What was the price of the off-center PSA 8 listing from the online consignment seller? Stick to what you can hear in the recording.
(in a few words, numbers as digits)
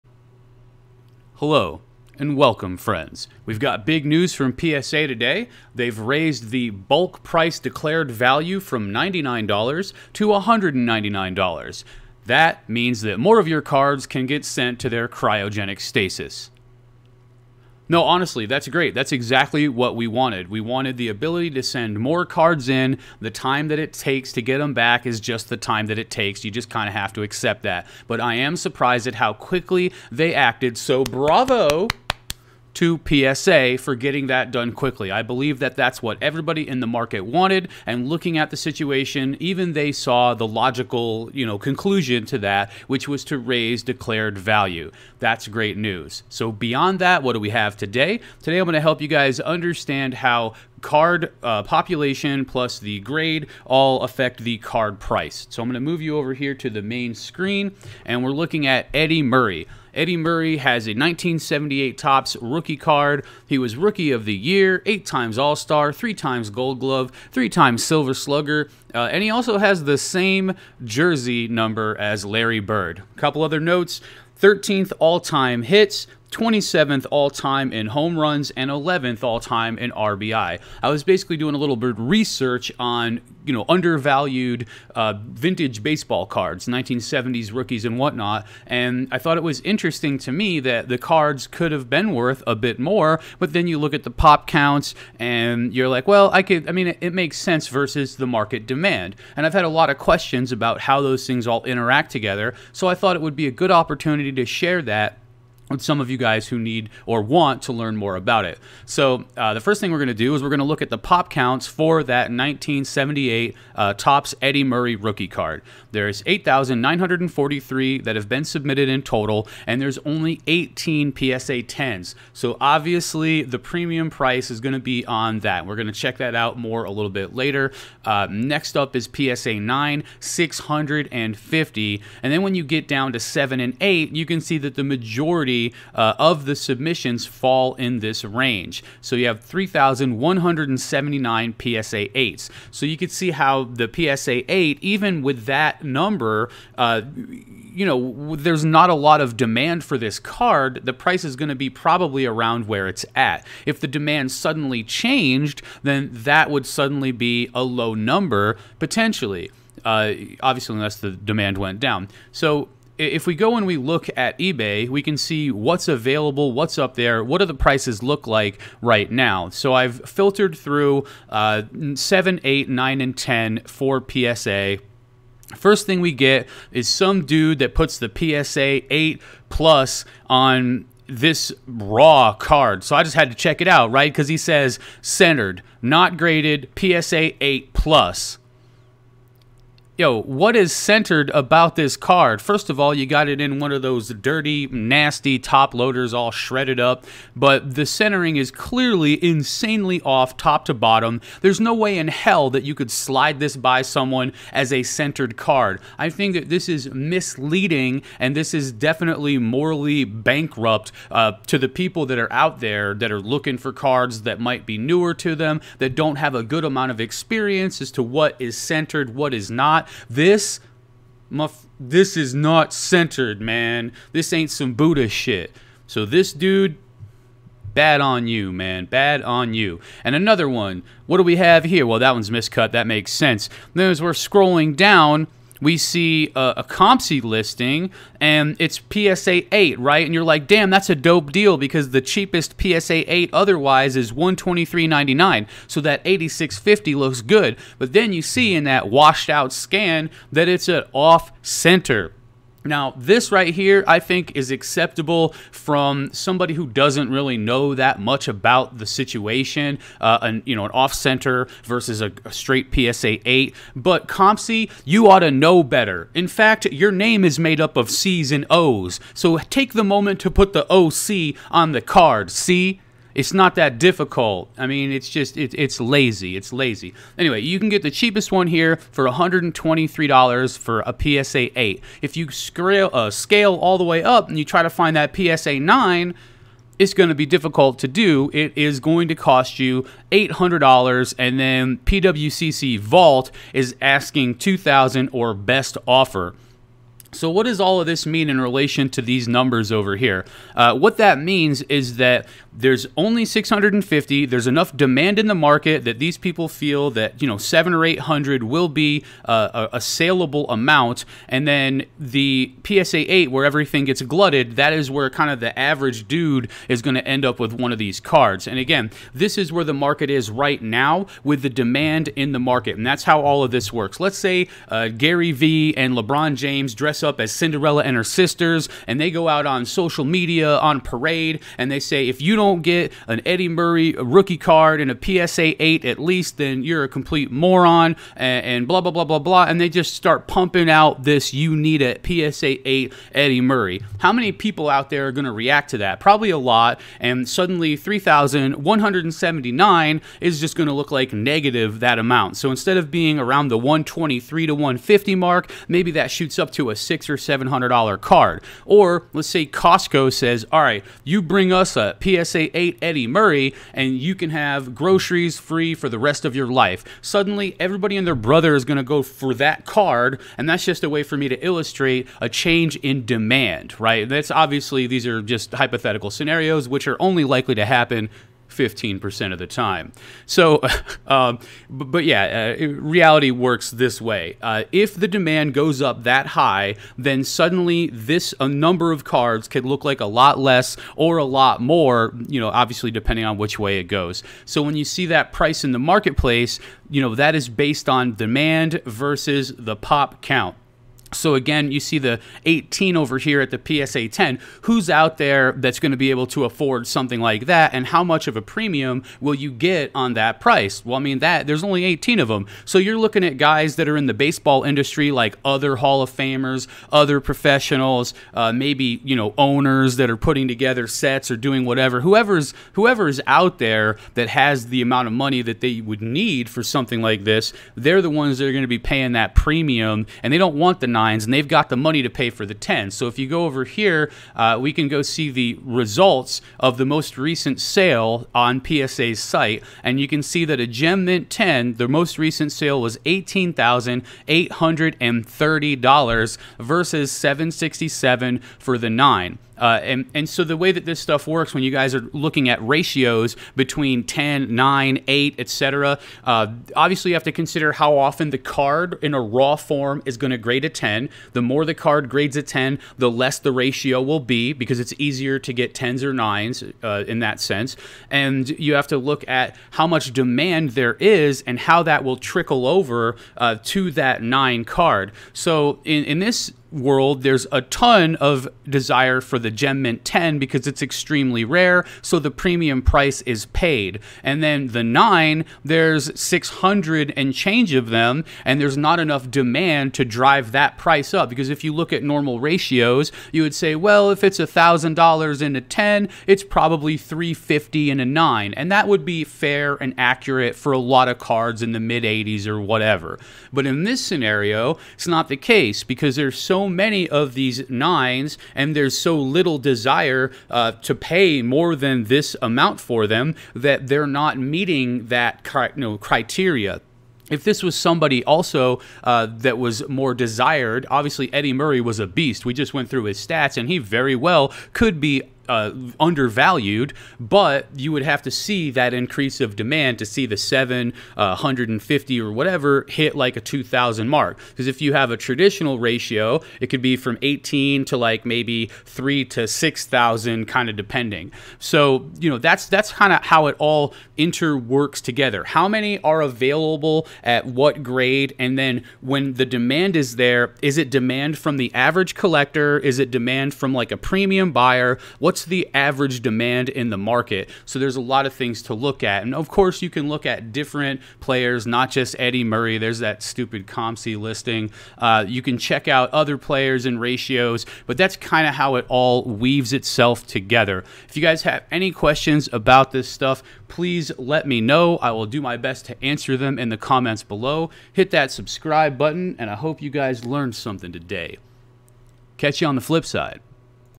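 $86.50.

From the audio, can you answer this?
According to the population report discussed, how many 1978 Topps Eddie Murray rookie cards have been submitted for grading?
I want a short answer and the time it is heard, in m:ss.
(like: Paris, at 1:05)
8,943, at 1:56.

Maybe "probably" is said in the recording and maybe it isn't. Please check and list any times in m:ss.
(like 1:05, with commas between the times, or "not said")
2:31, 5:45, 8:16.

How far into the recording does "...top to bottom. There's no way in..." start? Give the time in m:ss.
3:20.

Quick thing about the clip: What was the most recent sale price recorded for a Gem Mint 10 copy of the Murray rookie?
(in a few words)
$18,830.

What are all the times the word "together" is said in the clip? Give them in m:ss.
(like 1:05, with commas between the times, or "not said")
1:42, 7:00, 9:05, 9:30.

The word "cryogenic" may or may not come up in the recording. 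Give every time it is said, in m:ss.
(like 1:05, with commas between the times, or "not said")
0:15.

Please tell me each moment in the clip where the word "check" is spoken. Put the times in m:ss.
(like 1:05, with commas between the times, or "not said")
2:05, 3:03, 9:25.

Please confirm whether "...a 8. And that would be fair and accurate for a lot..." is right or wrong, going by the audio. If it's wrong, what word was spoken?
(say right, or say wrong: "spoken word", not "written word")
wrong: "9", not "8".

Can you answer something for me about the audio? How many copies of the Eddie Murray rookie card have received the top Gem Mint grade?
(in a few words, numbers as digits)
18.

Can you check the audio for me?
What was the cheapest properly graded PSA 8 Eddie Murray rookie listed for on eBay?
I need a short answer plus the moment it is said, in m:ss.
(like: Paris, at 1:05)
$123.99, at 4:04.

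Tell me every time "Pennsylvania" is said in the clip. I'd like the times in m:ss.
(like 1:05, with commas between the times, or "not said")
not said.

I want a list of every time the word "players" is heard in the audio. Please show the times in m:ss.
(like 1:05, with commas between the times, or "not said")
9:21, 9:26.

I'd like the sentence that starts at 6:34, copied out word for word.
So when you see that price in the marketplace, you know, that is based on demand versus the pop count.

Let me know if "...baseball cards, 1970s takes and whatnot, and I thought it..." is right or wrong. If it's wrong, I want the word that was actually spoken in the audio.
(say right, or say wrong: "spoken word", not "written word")
wrong: "rookies", not "takes".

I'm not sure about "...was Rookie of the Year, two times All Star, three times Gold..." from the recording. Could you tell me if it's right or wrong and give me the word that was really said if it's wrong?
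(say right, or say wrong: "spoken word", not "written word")
wrong: "eight", not "two".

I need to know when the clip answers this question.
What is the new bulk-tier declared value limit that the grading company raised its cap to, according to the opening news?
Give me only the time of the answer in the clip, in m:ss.
0:10.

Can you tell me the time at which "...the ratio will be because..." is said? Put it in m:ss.
7:43.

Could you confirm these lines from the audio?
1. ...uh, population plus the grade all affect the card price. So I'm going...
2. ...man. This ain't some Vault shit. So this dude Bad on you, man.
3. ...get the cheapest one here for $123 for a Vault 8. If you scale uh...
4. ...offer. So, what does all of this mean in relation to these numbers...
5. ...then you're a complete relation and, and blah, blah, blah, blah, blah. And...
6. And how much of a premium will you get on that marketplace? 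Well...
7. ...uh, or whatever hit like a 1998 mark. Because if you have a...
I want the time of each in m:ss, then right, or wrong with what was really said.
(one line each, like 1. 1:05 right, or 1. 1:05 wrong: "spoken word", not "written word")
1. 0:51 right
2. 3:43 wrong: "Buddha", not "Vault"
3. 4:37 wrong: "PSA", not "Vault"
4. 4:55 right
5. 5:36 wrong: "moron", not "relation"
6. 6:47 wrong: "price", not "marketplace"
7. 8:51 wrong: "2000", not "1998".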